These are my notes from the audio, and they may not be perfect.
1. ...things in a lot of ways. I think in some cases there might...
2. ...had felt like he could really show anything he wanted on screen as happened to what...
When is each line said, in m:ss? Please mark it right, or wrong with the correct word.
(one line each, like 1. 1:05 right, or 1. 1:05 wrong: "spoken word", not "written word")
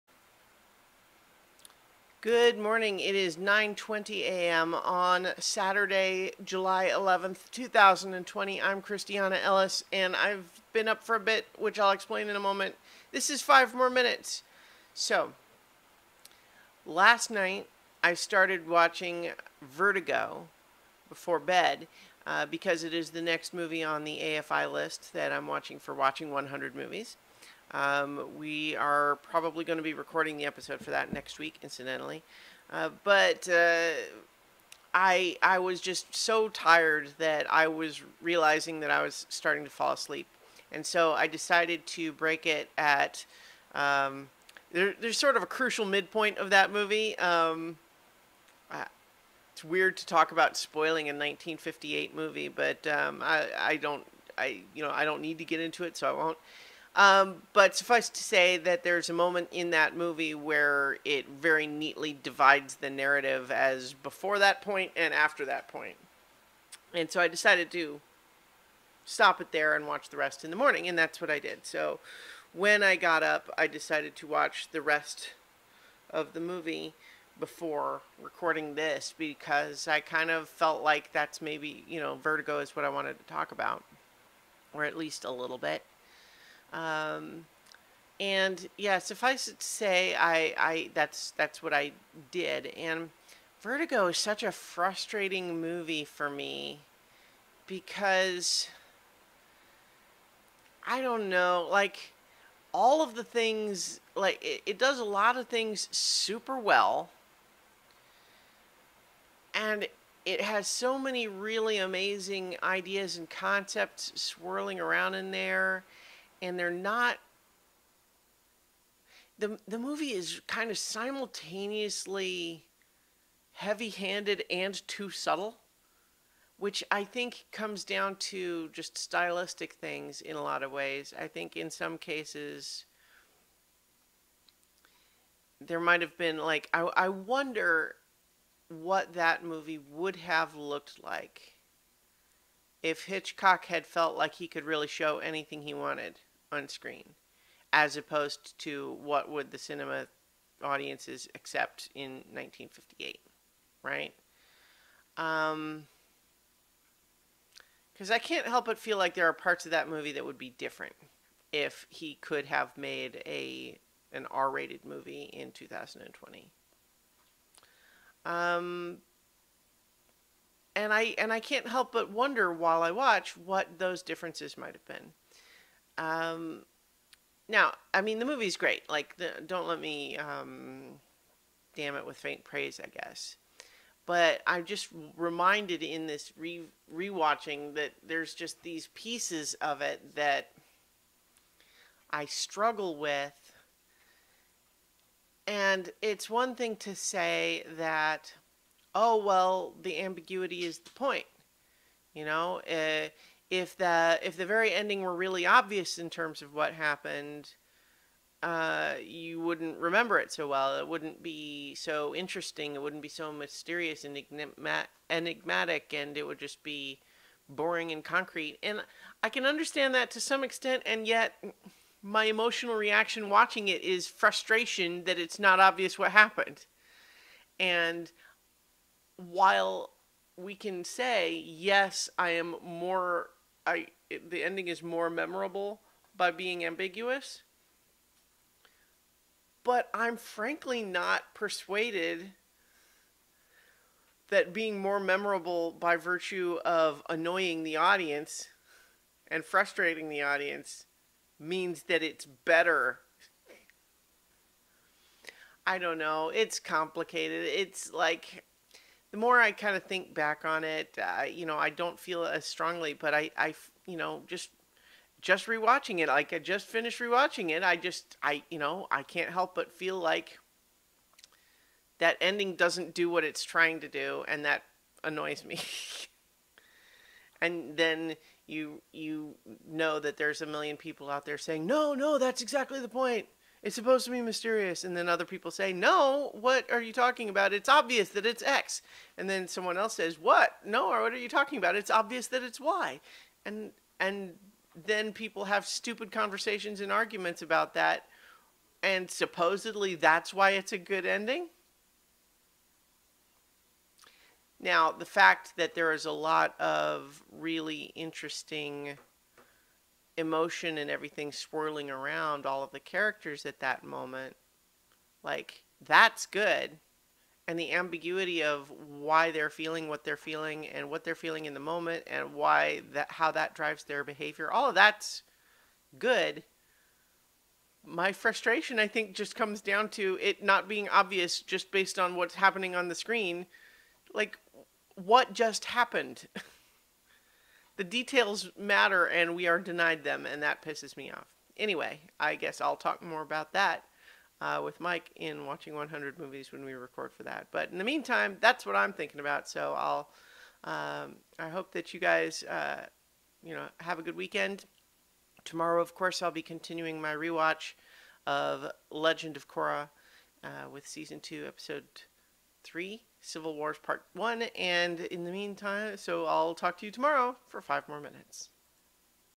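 1. 2:09 right
2. 2:23 wrong: "opposed", not "happened".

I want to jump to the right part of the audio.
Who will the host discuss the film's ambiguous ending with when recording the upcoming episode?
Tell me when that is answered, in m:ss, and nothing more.
5:44.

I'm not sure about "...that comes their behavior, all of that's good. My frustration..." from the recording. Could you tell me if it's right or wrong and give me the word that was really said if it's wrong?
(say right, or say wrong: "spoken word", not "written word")
wrong: "drives", not "comes".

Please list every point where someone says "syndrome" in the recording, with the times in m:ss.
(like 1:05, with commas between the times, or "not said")
not said.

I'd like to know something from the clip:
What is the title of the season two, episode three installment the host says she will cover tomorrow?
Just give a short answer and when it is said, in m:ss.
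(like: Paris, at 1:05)
Civil Wars Part 1, at 6:03.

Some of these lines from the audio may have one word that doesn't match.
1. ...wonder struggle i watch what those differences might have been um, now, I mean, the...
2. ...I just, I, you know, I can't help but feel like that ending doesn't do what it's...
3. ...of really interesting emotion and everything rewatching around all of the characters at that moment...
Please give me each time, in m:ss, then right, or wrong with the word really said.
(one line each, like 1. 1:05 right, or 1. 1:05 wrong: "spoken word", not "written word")
1. 2:52 wrong: "while", not "struggle"
2. 4:27 right
3. 5:06 wrong: "swirling", not "rewatching".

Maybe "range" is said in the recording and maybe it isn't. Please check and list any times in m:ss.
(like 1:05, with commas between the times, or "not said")
not said.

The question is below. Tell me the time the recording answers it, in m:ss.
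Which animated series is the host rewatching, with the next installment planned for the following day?
5:58.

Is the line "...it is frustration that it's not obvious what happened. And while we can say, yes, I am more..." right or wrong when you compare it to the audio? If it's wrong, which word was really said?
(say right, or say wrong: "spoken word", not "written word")
right.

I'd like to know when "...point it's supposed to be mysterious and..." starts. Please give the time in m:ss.
4:42.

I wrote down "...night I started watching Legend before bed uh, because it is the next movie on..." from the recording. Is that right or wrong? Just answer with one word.
wrong.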